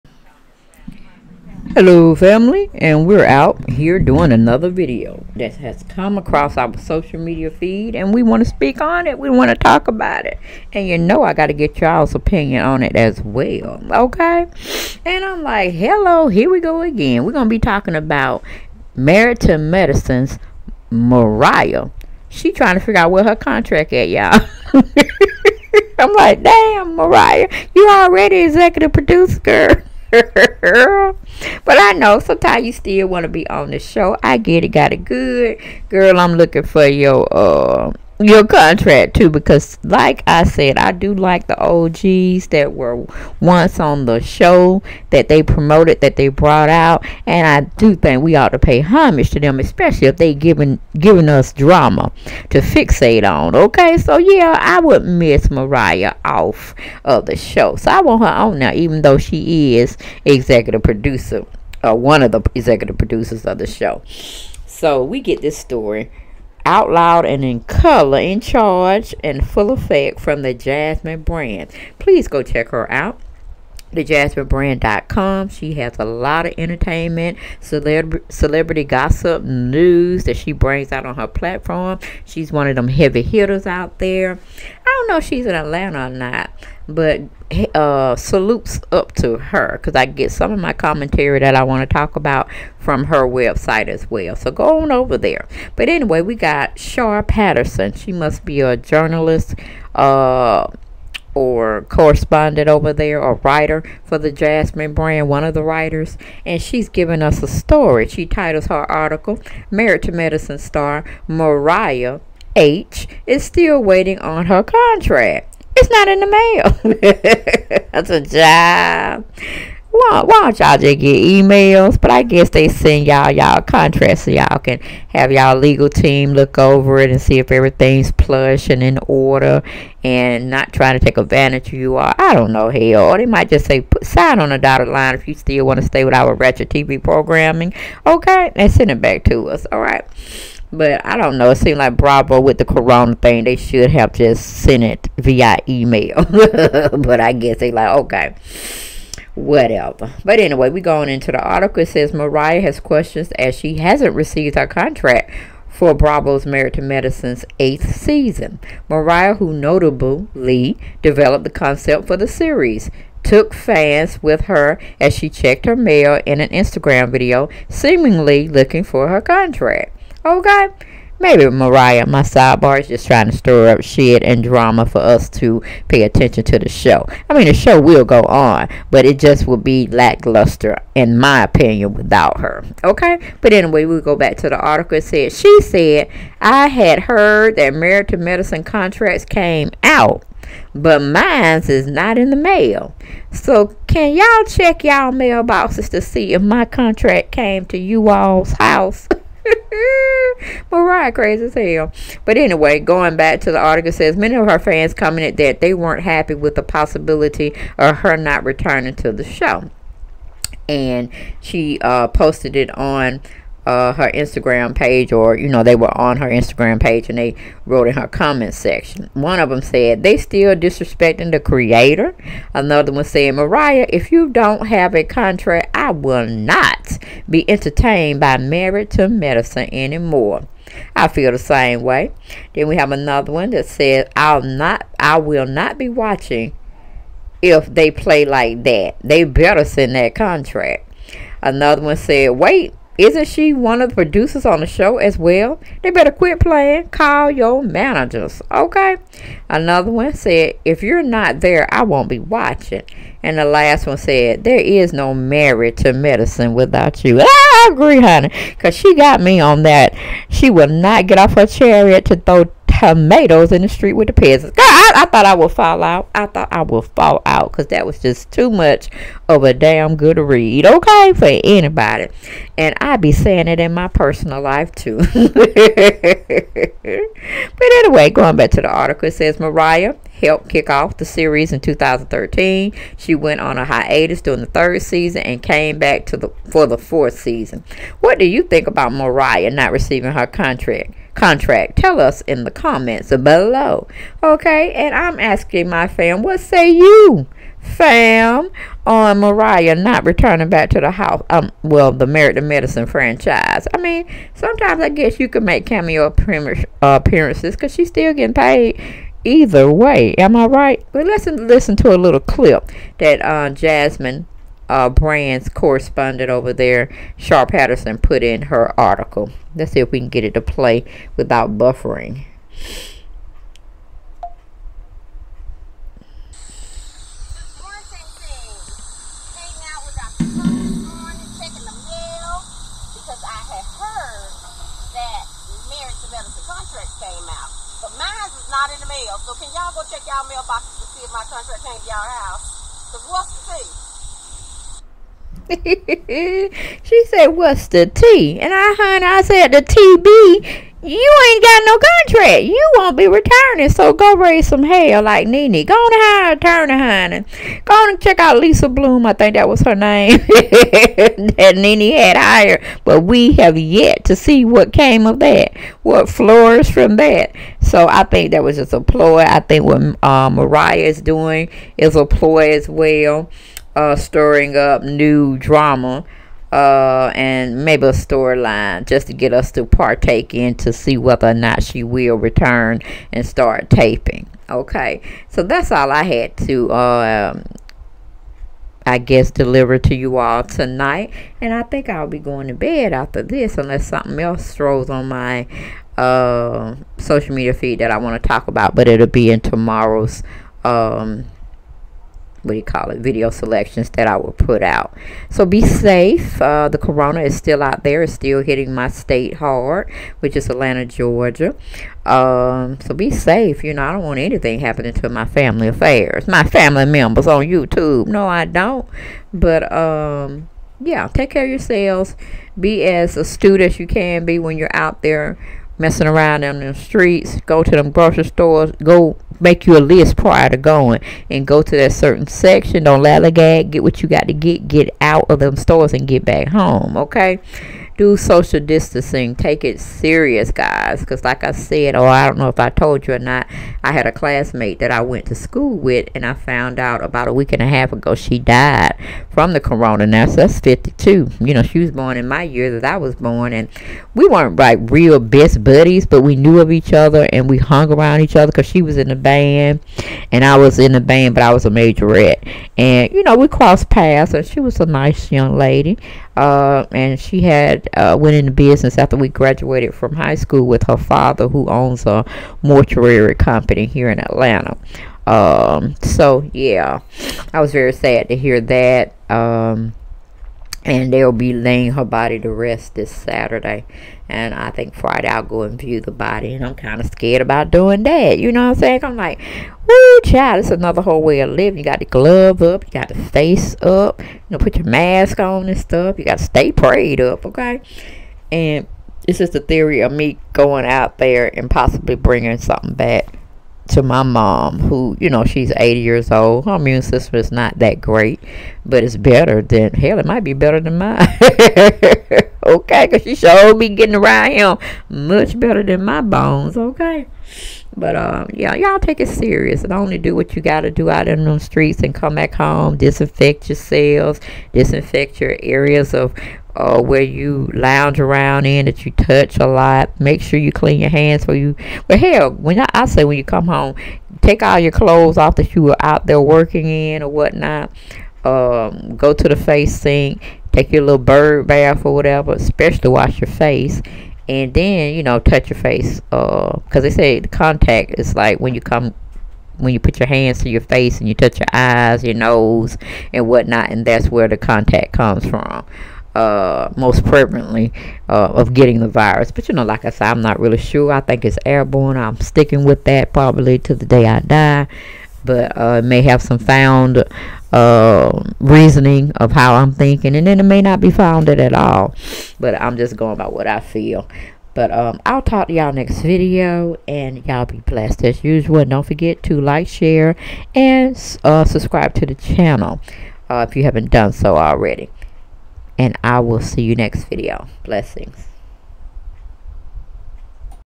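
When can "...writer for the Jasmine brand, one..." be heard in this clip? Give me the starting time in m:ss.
1:43.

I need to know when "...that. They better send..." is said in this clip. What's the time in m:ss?
3:58.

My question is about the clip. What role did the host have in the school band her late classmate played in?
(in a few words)
majorette.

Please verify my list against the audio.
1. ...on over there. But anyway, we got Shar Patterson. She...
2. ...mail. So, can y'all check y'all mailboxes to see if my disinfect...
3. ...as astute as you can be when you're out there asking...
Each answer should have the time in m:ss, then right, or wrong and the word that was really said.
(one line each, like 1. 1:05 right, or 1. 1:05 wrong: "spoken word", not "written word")
1. 1:34 right
2. 3:12 wrong: "contract", not "disinfect"
3. 7:02 wrong: "messing", not "asking".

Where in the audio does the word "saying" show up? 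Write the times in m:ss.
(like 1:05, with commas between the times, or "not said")
4:33, 8:08.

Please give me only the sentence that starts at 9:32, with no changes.
But I'm just going by what I feel.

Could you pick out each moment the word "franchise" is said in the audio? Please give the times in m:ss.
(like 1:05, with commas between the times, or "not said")
5:02.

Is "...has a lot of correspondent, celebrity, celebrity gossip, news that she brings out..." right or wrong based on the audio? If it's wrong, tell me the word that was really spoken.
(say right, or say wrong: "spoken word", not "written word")
wrong: "entertainment", not "correspondent".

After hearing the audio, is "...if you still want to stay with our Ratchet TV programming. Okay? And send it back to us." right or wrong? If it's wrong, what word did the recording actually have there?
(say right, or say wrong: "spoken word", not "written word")
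right.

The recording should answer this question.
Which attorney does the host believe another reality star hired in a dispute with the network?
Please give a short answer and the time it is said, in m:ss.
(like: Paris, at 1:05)
Lisa Bloom, at 5:58.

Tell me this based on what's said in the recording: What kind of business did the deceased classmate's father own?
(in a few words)
mortuary company.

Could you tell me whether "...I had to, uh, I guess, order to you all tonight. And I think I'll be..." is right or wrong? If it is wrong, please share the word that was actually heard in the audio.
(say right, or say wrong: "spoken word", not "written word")
wrong: "deliver", not "order".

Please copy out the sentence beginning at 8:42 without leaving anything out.
Disinfect yourselves, disinfect your areas of uh, where you lounge around in that you touch a lot.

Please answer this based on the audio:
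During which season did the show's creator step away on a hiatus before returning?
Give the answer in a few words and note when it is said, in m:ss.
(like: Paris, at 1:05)
third season, at 4:44.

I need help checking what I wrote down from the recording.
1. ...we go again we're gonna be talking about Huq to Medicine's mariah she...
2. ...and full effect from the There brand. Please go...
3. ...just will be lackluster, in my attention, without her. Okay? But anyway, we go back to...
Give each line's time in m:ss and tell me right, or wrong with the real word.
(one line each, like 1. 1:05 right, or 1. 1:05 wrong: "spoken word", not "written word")
1. 0:16 wrong: "Married", not "Huq"
2. 1:09 wrong: "Jasmine", not "There"
3. 2:59 wrong: "opinion", not "attention".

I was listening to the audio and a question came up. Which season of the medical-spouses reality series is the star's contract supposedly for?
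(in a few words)
8th.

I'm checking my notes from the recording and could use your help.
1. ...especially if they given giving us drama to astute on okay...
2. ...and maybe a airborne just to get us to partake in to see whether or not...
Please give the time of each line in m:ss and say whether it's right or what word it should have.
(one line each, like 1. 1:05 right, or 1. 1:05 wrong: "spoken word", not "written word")
1. 0:49 wrong: "fixate", not "astute"
2. 6:17 wrong: "storyline", not "airborne".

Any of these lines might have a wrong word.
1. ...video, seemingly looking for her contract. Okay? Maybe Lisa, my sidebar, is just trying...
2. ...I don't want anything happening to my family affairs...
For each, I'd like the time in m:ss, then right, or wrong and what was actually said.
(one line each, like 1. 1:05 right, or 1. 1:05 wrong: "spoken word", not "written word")
1. 2:47 wrong: "Mariah", not "Lisa"
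2. 6:53 right.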